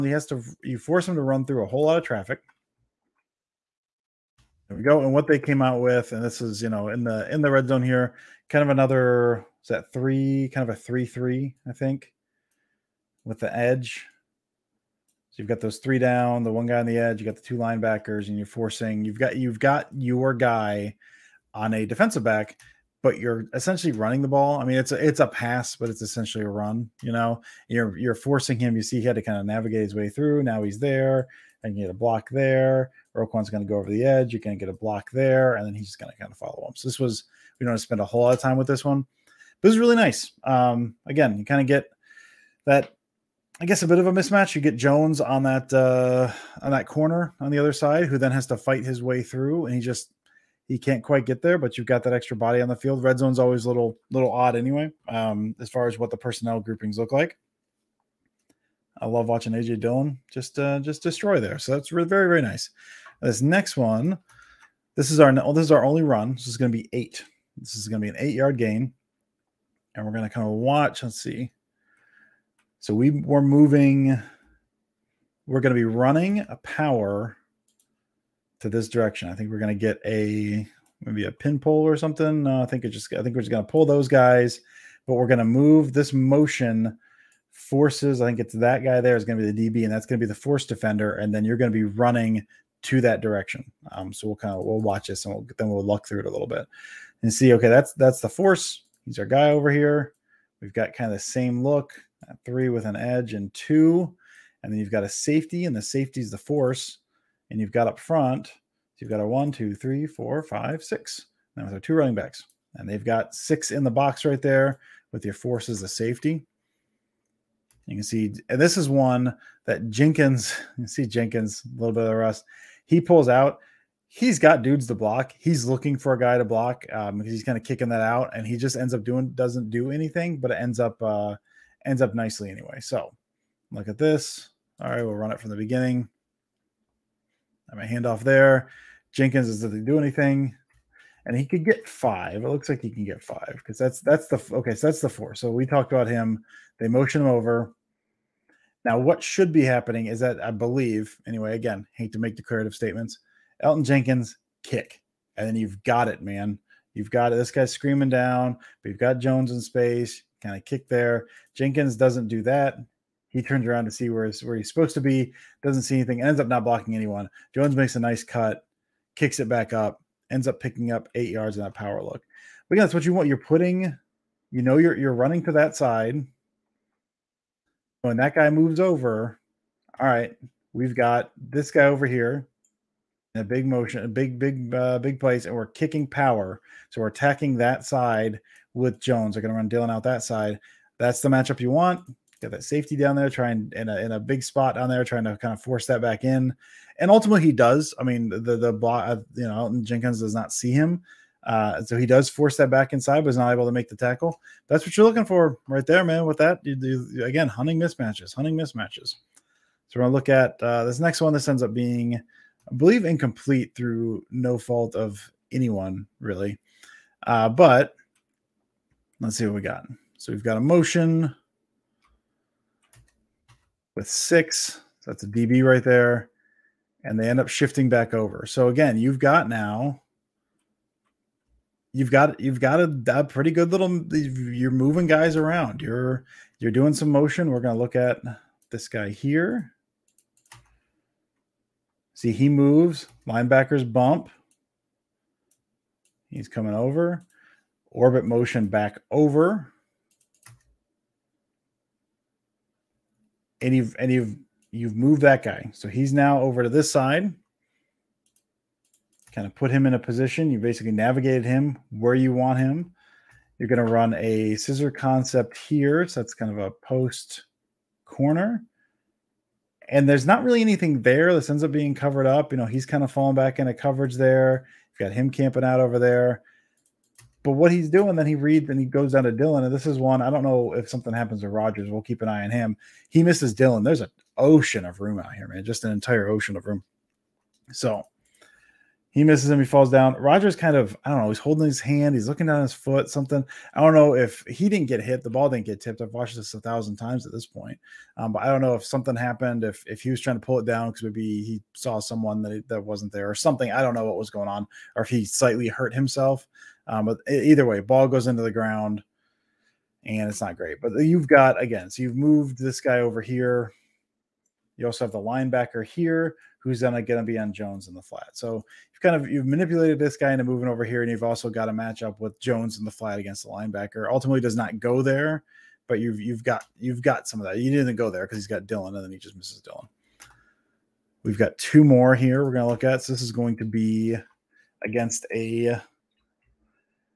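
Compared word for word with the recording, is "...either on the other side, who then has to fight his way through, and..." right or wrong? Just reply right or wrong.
wrong.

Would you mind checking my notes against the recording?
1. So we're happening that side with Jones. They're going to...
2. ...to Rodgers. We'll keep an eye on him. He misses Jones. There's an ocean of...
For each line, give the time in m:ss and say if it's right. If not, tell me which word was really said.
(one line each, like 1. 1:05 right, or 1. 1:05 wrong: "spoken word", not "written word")
1. 3:06 wrong: "attacking", not "happening"
2. 4:41 wrong: "Dillon", not "Jones".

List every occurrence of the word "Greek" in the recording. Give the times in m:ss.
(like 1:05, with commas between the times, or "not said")
not said.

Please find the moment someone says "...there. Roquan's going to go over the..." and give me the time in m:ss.
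0:32.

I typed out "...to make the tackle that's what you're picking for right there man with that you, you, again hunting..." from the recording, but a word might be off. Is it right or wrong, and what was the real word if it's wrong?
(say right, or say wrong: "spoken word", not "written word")
wrong: "looking", not "picking".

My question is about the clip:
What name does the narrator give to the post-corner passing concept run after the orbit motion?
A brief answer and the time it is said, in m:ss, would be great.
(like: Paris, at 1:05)
scissor concept, at 4:24.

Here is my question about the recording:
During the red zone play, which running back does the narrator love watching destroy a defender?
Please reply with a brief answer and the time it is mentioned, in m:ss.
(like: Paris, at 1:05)
AJ Dillon, at 0:59.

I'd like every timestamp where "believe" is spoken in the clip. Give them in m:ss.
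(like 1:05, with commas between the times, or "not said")
2:30, 3:32.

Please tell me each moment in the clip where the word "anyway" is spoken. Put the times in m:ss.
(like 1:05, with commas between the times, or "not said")
0:54, 2:12, 2:31.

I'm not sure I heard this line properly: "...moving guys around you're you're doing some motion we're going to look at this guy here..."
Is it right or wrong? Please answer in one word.
right.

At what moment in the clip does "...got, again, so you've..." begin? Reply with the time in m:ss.
5:11.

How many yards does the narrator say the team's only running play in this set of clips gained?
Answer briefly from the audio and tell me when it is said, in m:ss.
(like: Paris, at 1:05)
8, at 1:08.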